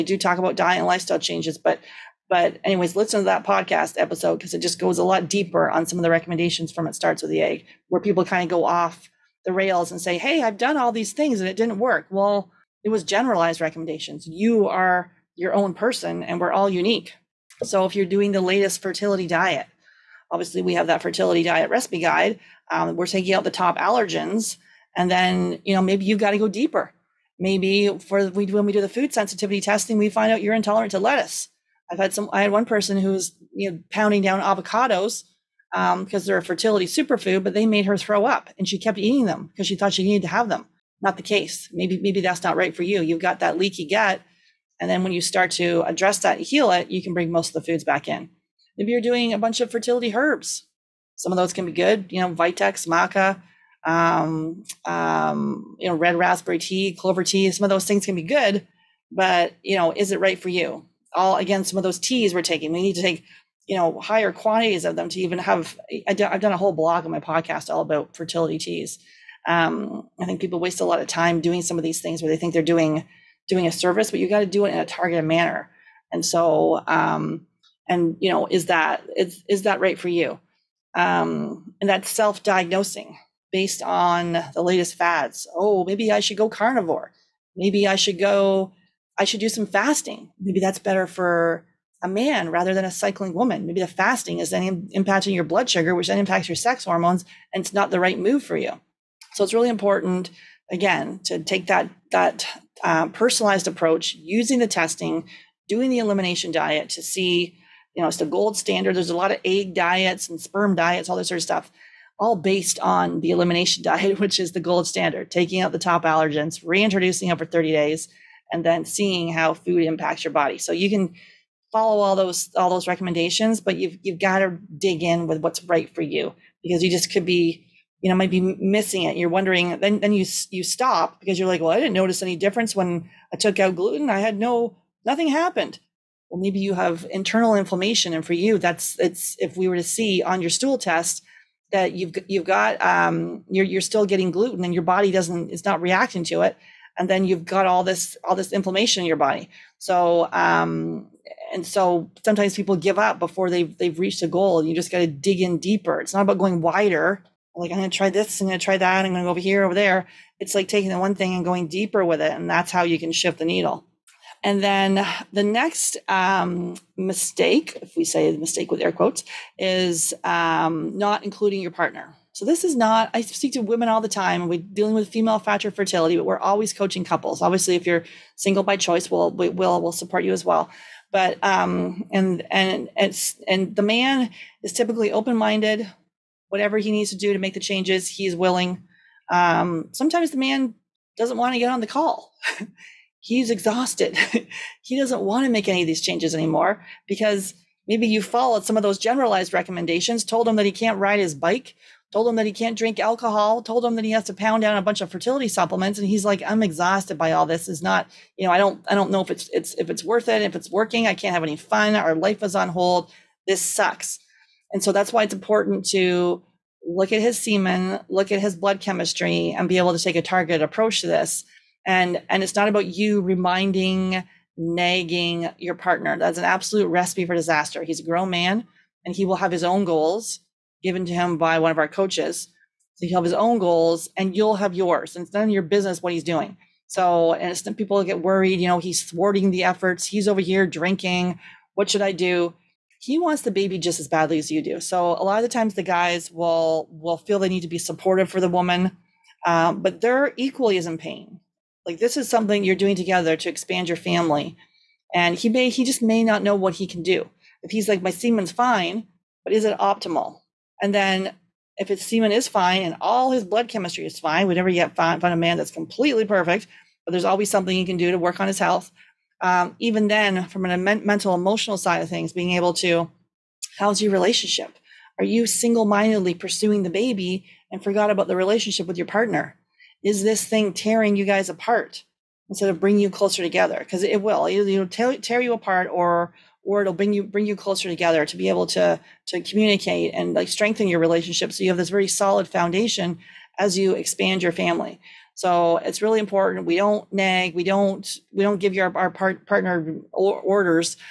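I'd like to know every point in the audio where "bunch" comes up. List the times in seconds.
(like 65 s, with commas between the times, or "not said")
49 s, 204 s.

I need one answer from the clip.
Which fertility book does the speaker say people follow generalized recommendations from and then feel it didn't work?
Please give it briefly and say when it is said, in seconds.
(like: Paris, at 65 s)
It Starts with the Egg, at 6 s.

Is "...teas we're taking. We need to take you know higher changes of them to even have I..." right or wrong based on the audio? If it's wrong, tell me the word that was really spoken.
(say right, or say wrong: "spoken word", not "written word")
wrong: "quantities", not "changes".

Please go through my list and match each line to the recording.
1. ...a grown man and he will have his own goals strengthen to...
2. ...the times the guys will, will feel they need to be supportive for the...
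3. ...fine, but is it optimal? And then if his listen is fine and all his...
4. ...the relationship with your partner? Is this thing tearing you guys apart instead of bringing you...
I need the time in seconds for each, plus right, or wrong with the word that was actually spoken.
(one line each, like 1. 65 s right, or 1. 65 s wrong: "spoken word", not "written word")
1. 227 s wrong: "given", not "strengthen"
2. 245 s right
3. 258 s wrong: "semen", not "listen"
4. 278 s right.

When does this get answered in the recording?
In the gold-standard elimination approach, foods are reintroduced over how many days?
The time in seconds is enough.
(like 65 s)
117 s.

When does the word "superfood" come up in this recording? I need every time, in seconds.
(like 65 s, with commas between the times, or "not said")
36 s.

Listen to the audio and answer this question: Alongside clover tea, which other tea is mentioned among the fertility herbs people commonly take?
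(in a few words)
red raspberry tea.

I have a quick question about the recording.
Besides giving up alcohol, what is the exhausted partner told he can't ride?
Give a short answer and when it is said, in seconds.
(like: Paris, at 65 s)
bike, at 201 s.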